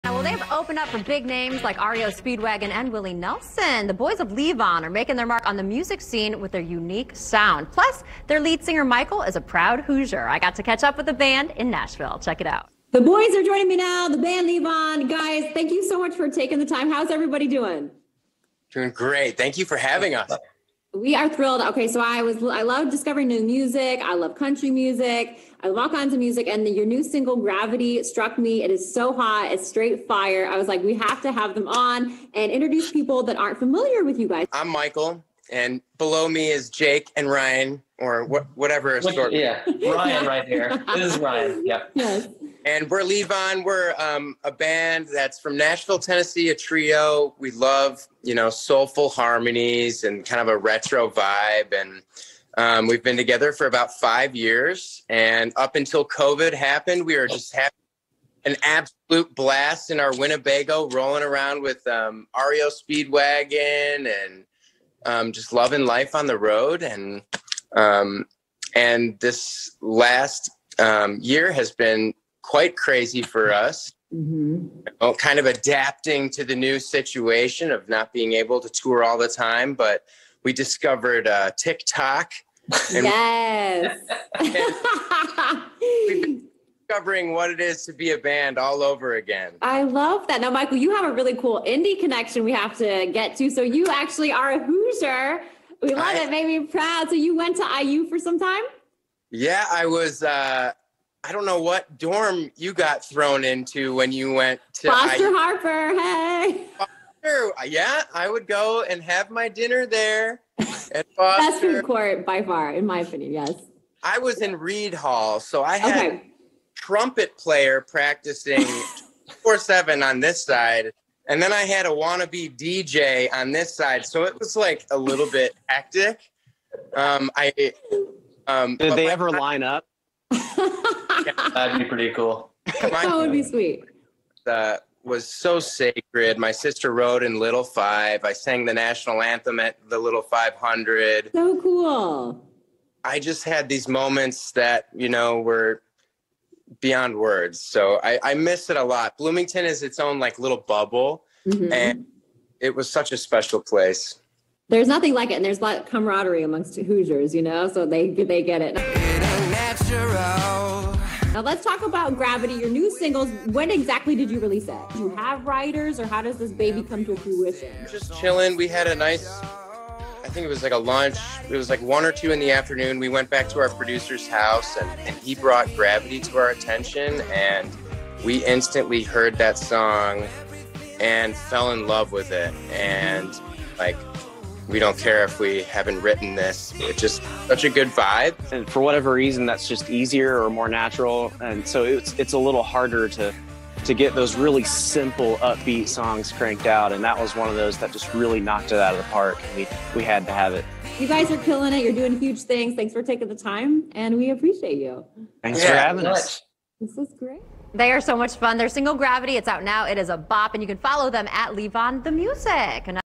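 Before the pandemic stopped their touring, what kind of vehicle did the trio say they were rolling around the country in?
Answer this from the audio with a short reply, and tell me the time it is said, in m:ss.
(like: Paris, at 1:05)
Winnebago, at 1:00.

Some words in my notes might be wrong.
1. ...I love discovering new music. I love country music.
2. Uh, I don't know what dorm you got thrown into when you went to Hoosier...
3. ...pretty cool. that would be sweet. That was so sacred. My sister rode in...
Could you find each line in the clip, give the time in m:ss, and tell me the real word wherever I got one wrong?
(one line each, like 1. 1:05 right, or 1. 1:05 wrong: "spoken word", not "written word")
1. 0:22 right
2. 1:40 wrong: "Foster", not "Hoosier"
3. 2:11 right.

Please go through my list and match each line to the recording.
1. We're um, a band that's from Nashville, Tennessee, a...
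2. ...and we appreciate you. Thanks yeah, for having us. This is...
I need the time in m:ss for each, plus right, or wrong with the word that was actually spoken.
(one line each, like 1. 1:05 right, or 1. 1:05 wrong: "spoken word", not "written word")
1. 0:43 right
2. 3:23 right.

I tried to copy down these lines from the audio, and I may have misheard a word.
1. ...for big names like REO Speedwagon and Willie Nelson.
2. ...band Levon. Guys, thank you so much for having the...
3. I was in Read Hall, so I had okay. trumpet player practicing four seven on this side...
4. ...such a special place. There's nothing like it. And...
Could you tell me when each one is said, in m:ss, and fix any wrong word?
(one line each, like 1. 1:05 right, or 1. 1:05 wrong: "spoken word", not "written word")
1. 0:00 right
2. 0:14 wrong: "taking", not "having"
3. 1:54 right
4. 2:32 right.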